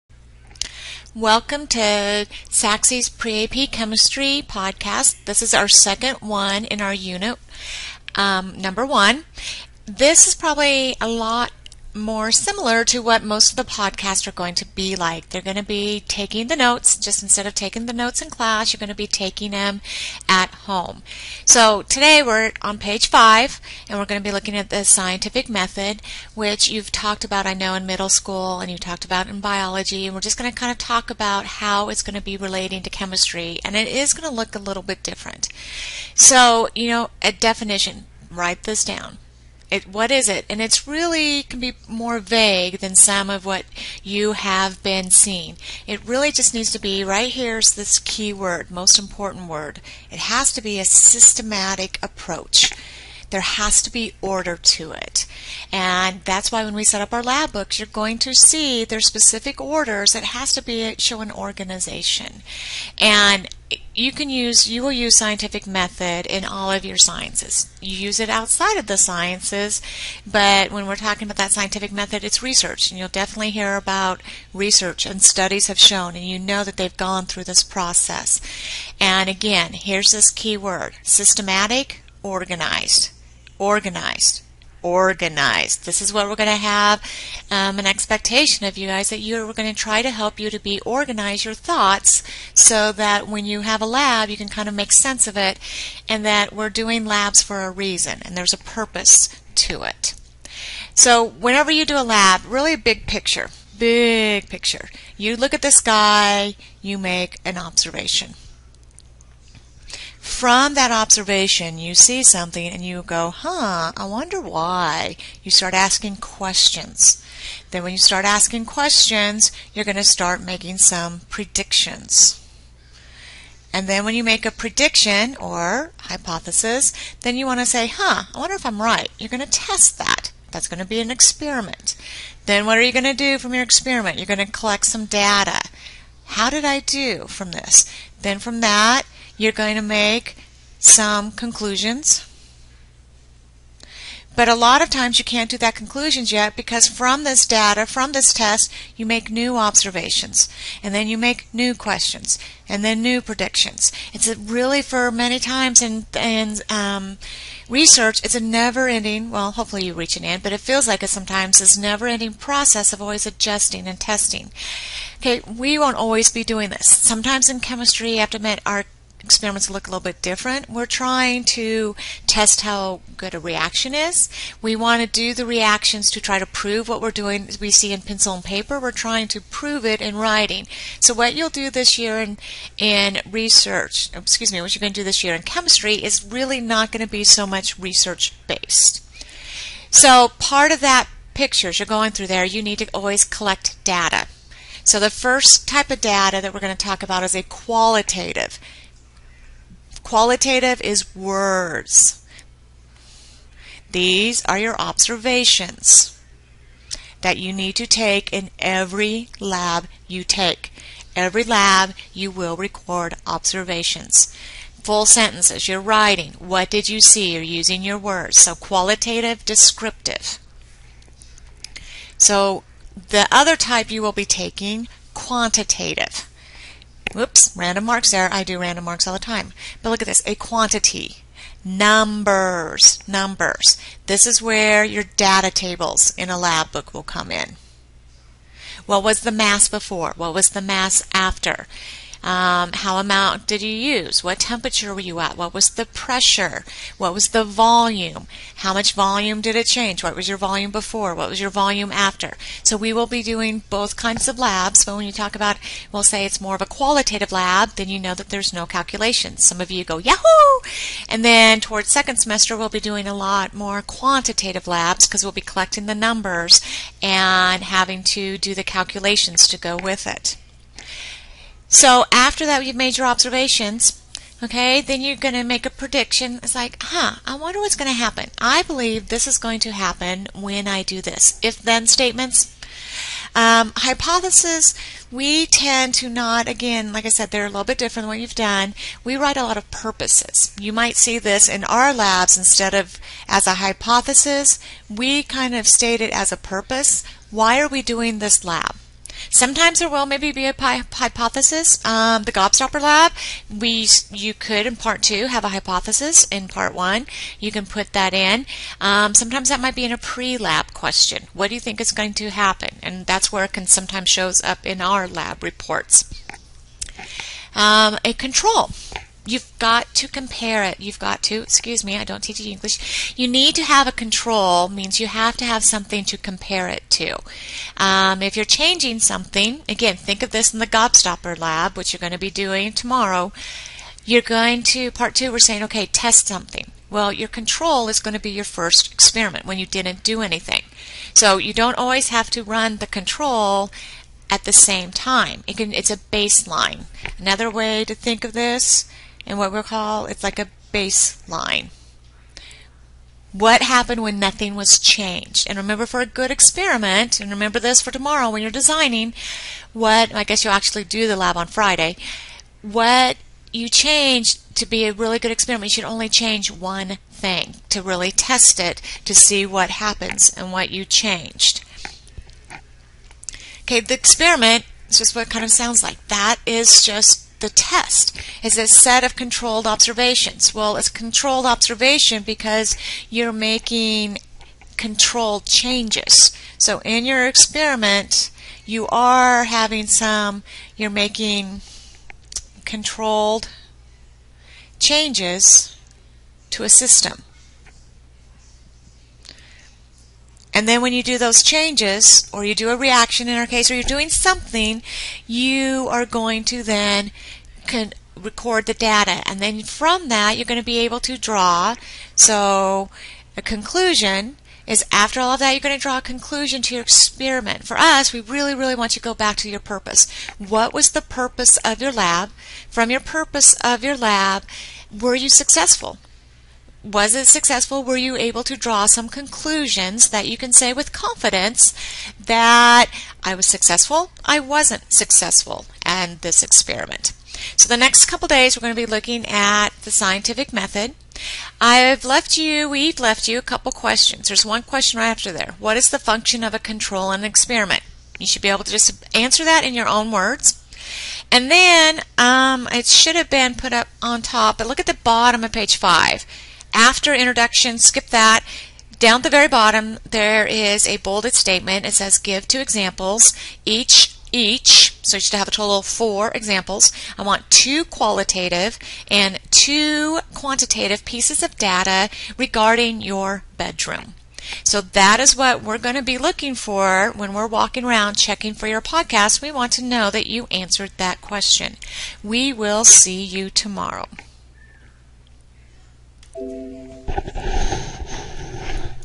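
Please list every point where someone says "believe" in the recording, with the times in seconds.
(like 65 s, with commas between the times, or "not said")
278 s.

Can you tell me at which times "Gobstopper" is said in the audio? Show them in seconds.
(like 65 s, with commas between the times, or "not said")
302 s, 330 s.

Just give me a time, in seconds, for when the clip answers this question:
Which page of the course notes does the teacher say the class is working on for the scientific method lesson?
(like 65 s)
22 s.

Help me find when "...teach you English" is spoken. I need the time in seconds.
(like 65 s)
322 s.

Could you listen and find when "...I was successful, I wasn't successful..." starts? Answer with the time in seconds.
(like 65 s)
433 s.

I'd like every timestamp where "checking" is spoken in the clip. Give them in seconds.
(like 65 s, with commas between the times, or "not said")
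478 s.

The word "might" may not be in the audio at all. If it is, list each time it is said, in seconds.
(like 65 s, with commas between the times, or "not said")
290 s, 309 s.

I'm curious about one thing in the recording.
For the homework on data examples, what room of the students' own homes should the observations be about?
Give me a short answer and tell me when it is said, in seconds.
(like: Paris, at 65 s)
Bedroom, at 473 s.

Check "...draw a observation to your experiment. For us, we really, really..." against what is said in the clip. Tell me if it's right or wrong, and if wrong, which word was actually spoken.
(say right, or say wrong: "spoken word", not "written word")
wrong: "conclusion", not "observation".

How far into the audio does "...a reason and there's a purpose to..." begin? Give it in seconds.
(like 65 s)
97 s.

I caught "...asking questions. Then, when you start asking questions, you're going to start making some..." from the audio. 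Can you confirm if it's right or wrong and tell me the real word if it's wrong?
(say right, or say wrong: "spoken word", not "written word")
right.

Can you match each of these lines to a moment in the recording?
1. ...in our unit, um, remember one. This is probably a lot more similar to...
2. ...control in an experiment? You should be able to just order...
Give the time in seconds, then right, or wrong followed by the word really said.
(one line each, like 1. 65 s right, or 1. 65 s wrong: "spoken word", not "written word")
1. 6 s wrong: "number", not "remember"
2. 446 s wrong: "answer", not "order".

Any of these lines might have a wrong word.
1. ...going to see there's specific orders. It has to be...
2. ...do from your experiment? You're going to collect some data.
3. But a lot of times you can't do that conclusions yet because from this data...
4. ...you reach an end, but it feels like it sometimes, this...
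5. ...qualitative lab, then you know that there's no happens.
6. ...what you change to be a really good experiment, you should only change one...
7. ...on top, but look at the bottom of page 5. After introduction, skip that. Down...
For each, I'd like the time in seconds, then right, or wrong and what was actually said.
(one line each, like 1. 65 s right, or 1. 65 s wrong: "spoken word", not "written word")
1. 57 s right
2. 133 s right
3. 144 s right
4. 159 s right
5. 256 s wrong: "calculations", not "happens"
6. 362 s right
7. 454 s right.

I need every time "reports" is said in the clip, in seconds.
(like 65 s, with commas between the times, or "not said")
315 s.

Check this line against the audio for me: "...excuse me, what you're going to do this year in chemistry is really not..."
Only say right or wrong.
right.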